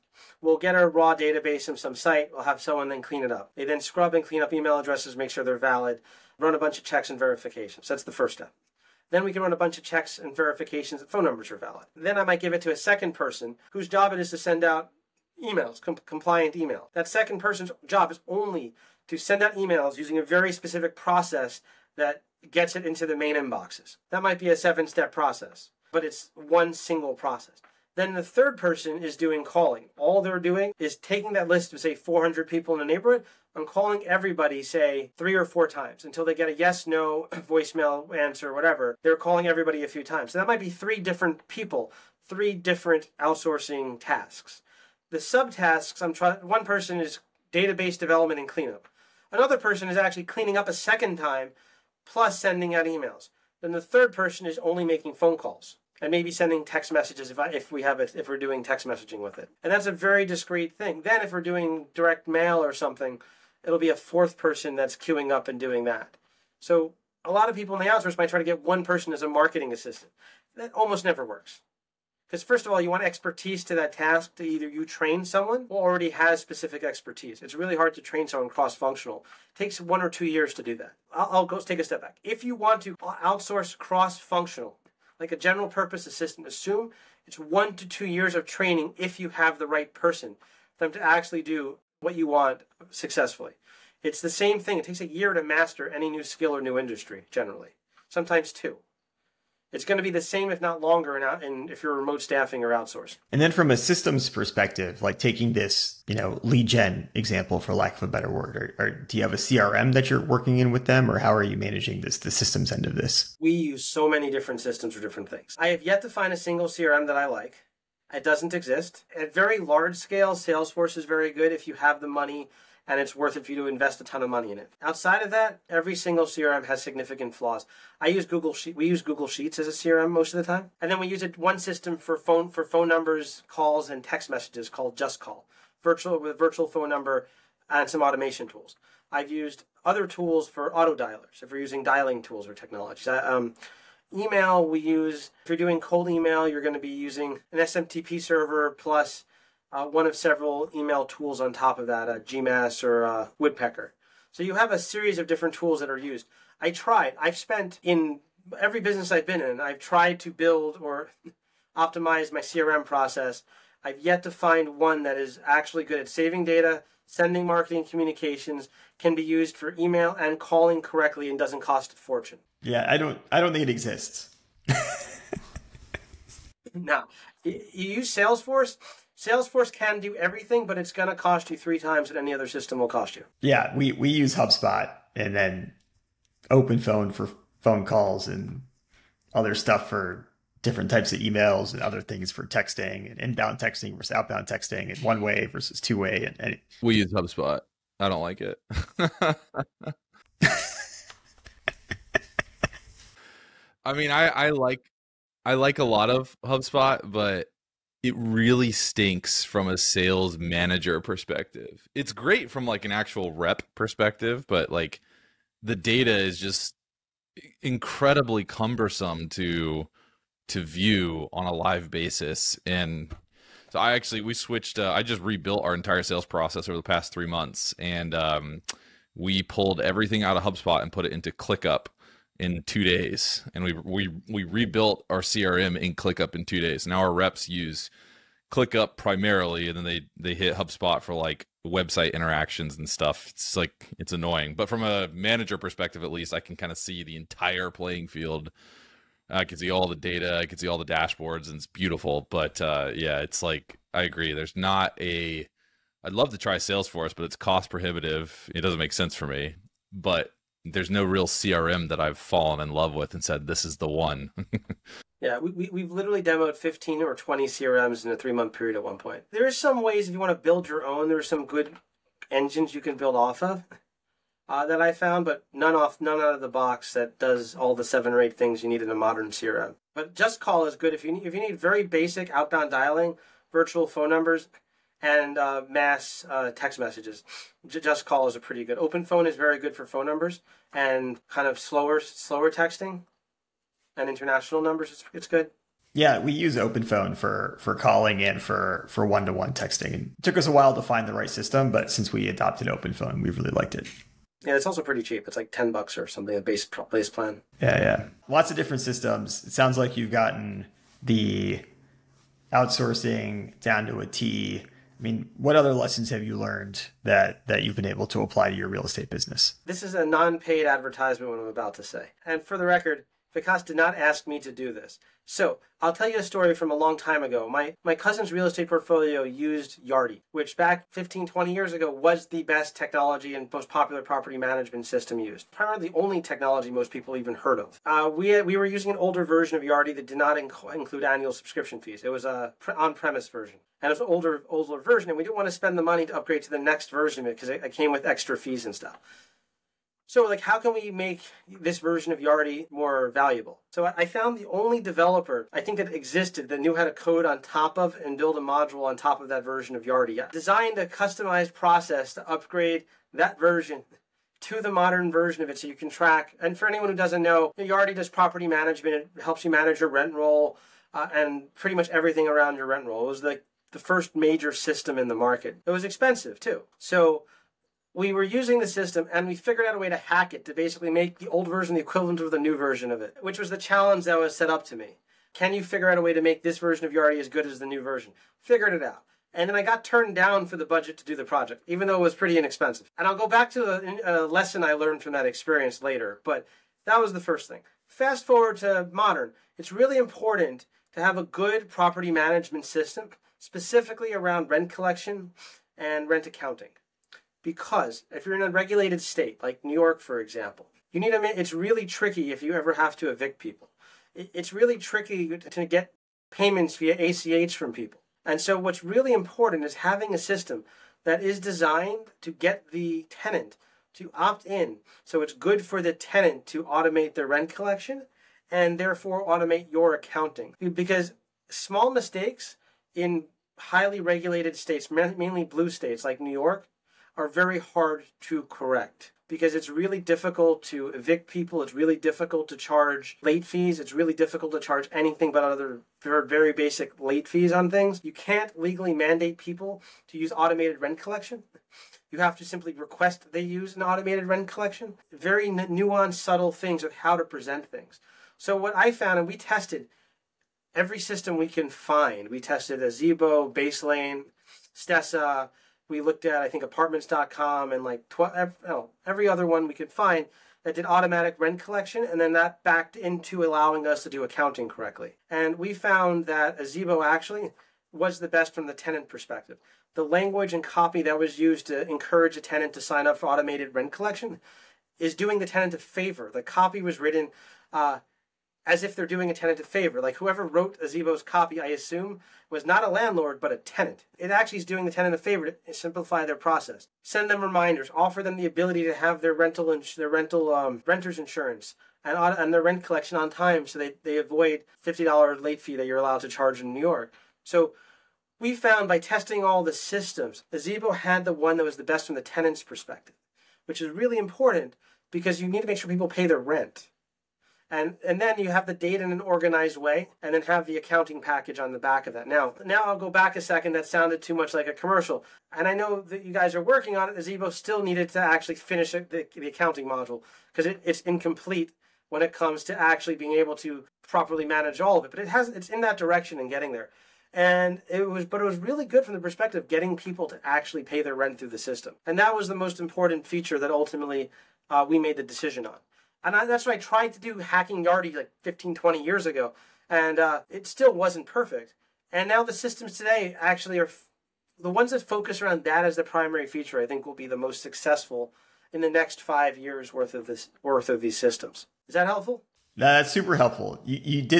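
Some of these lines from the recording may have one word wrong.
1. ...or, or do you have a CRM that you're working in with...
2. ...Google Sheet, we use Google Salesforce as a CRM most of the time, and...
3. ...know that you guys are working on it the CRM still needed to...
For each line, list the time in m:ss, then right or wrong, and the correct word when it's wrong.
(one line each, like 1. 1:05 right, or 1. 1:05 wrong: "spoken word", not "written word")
1. 1:48 right
2. 2:08 wrong: "Sheets", not "Salesforce"
3. 8:45 wrong: "Azibo", not "CRM".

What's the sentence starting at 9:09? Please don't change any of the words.
And uh, it still wasn't perfect.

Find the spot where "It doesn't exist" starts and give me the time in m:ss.
1:58.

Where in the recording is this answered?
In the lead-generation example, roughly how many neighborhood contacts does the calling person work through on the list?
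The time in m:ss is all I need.
0:31.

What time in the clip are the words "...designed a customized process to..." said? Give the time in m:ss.
6:00.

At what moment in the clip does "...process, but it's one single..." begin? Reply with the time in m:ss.
0:25.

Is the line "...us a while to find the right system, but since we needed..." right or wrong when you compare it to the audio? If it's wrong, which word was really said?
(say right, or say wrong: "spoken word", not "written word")
wrong: "adopted", not "needed".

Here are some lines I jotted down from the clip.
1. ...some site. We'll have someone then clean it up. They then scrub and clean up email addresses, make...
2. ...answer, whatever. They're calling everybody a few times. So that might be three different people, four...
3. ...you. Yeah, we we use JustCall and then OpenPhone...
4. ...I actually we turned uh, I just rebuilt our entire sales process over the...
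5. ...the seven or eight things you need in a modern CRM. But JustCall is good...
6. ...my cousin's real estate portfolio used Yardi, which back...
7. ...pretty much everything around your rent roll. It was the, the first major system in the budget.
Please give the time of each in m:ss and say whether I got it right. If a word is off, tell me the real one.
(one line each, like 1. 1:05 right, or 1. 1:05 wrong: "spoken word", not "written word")
1. 0:01 right
2. 0:38 wrong: "three", not "four"
3. 3:03 wrong: "HubSpot", not "JustCall"
4. 3:43 wrong: "switched", not "turned"
5. 4:37 right
6. 5:27 right
7. 6:11 wrong: "market", not "budget".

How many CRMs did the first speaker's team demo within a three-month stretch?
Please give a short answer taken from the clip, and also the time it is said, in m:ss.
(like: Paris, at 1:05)
15 or 20, at 4:26.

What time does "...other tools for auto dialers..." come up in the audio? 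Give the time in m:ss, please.
2:19.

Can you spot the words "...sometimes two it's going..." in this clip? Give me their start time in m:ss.
1:38.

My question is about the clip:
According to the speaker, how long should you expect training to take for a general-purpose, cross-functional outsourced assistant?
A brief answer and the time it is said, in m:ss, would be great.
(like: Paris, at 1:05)
1 to 2 years, at 1:27.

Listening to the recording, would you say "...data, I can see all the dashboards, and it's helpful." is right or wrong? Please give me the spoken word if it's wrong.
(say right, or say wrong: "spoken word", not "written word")
wrong: "beautiful", not "helpful".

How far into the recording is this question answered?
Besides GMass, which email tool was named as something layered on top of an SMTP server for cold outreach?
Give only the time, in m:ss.
2:33.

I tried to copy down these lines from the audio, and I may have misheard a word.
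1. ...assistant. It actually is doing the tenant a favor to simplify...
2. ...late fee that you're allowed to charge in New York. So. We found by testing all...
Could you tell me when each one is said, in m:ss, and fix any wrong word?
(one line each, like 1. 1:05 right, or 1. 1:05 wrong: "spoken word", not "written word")
1. 8:13 wrong: "tenant", not "assistant"
2. 8:25 right.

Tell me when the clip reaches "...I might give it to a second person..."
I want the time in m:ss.
0:12.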